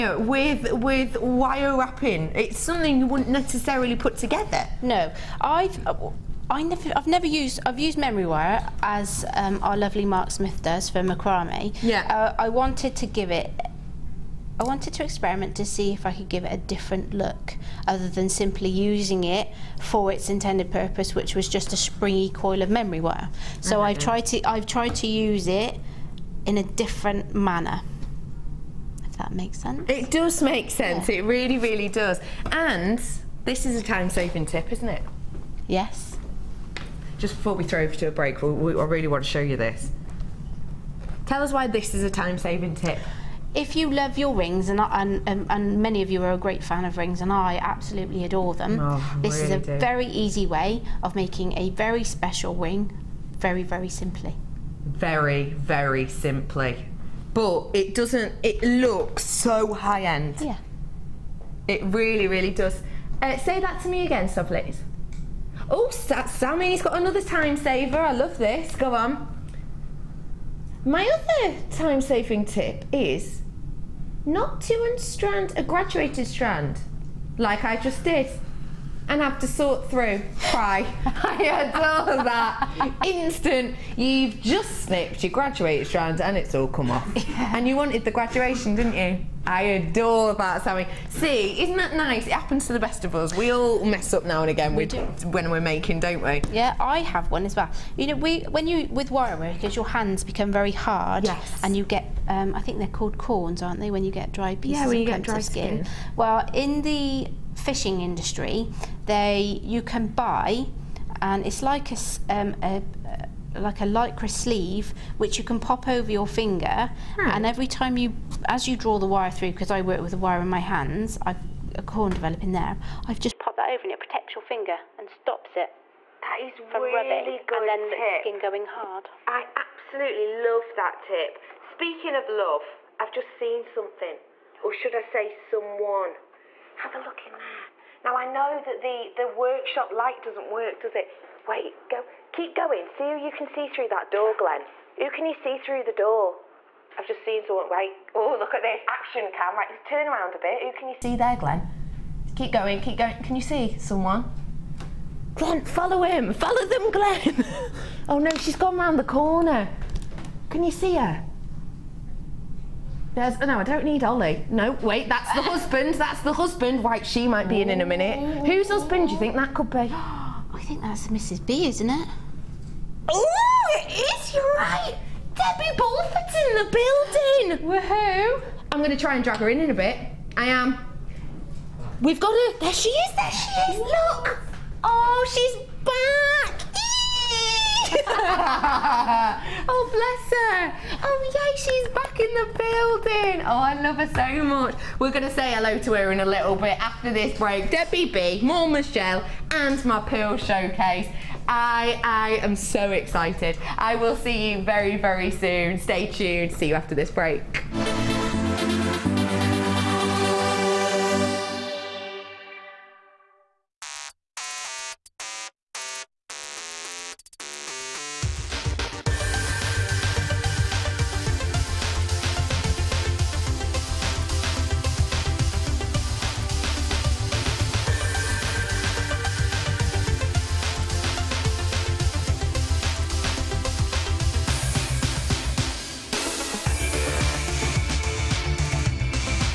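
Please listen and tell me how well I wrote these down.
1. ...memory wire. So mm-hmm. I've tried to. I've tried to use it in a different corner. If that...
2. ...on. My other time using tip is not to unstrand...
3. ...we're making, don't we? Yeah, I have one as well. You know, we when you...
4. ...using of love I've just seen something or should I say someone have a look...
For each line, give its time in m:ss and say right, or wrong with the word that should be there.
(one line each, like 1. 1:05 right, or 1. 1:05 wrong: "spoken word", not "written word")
1. 0:22 wrong: "manner", not "corner"
2. 1:08 wrong: "saving", not "using"
3. 1:35 right
4. 2:11 wrong: "speaking", not "using".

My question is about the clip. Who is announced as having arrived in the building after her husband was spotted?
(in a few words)
Debbie Bulford.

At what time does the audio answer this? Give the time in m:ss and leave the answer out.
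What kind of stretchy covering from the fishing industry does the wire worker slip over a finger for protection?
1:53.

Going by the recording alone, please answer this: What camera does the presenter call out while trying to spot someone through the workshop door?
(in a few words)
action cam.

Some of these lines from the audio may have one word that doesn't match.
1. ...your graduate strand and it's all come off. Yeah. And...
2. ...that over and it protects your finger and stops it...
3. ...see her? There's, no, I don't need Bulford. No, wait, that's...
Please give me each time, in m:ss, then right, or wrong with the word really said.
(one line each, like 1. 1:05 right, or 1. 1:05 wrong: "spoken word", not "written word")
1. 1:25 right
2. 2:03 right
3. 2:40 wrong: "Ollie", not "Bulford".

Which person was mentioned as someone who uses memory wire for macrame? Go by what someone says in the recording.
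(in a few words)
Mark Smith.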